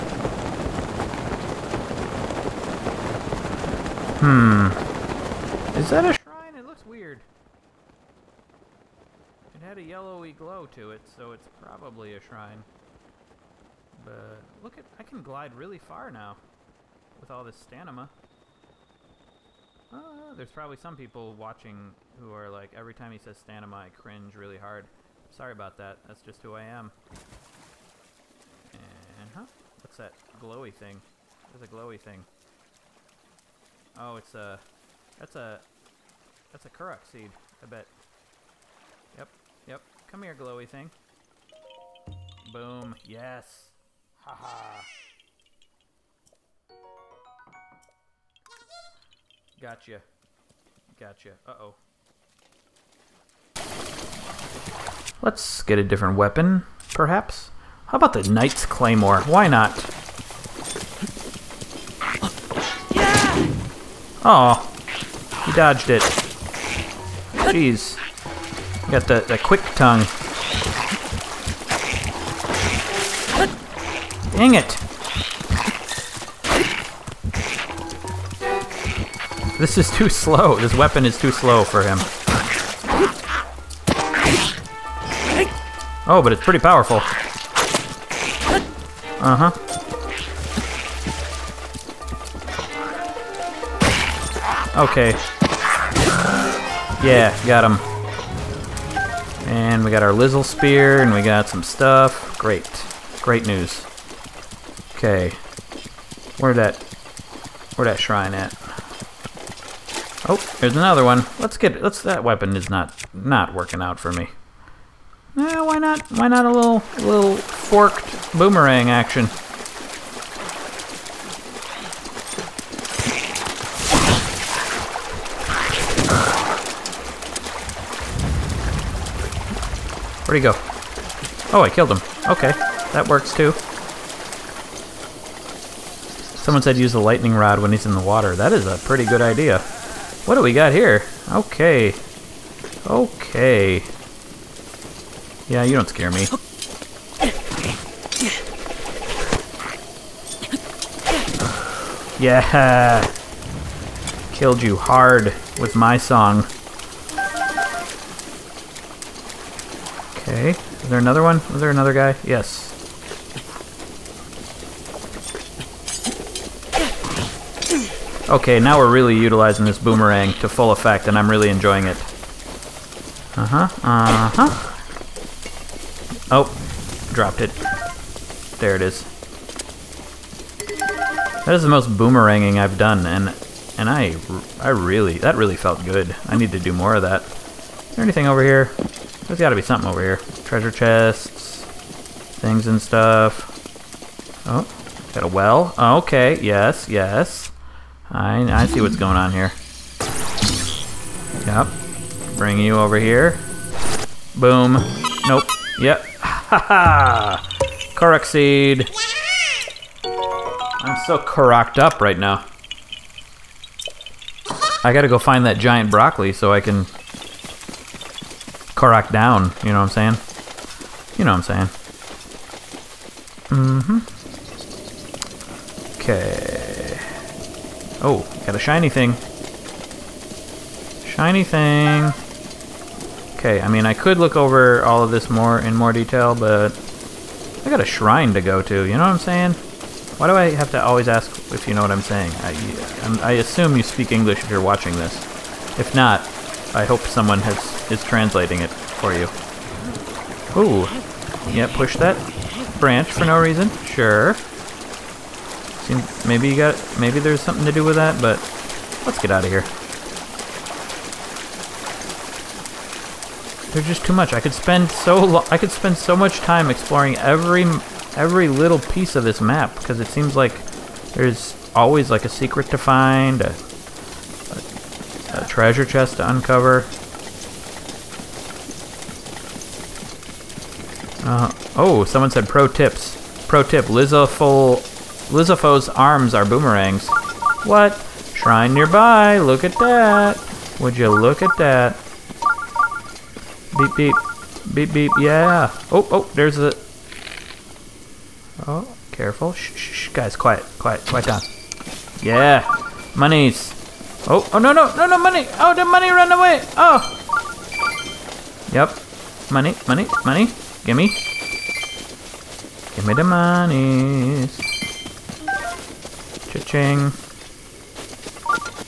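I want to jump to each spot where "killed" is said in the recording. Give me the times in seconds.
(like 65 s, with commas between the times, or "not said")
131 s, 154 s.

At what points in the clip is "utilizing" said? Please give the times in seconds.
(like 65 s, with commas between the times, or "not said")
169 s.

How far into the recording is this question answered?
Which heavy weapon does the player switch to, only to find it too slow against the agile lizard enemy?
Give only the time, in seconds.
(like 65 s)
58 s.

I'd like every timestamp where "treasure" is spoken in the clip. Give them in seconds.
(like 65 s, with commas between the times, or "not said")
190 s, 275 s.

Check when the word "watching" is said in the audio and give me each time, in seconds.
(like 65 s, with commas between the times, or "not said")
21 s, 244 s.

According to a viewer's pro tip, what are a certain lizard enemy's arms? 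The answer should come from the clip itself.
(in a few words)
boomerangs.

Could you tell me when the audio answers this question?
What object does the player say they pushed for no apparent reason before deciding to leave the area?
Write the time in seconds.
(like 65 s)
252 s.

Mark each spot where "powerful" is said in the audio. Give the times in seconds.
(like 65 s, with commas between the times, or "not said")
86 s.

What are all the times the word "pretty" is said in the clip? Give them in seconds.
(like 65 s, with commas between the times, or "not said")
86 s, 138 s.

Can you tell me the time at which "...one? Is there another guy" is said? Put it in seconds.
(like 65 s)
161 s.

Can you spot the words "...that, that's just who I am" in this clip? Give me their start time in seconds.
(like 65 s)
25 s.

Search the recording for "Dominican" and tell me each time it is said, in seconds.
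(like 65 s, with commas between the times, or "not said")
not said.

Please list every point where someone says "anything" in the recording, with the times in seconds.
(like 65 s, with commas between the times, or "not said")
188 s.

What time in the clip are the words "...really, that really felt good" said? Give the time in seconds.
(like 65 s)
184 s.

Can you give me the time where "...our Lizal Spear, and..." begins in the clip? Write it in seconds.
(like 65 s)
100 s.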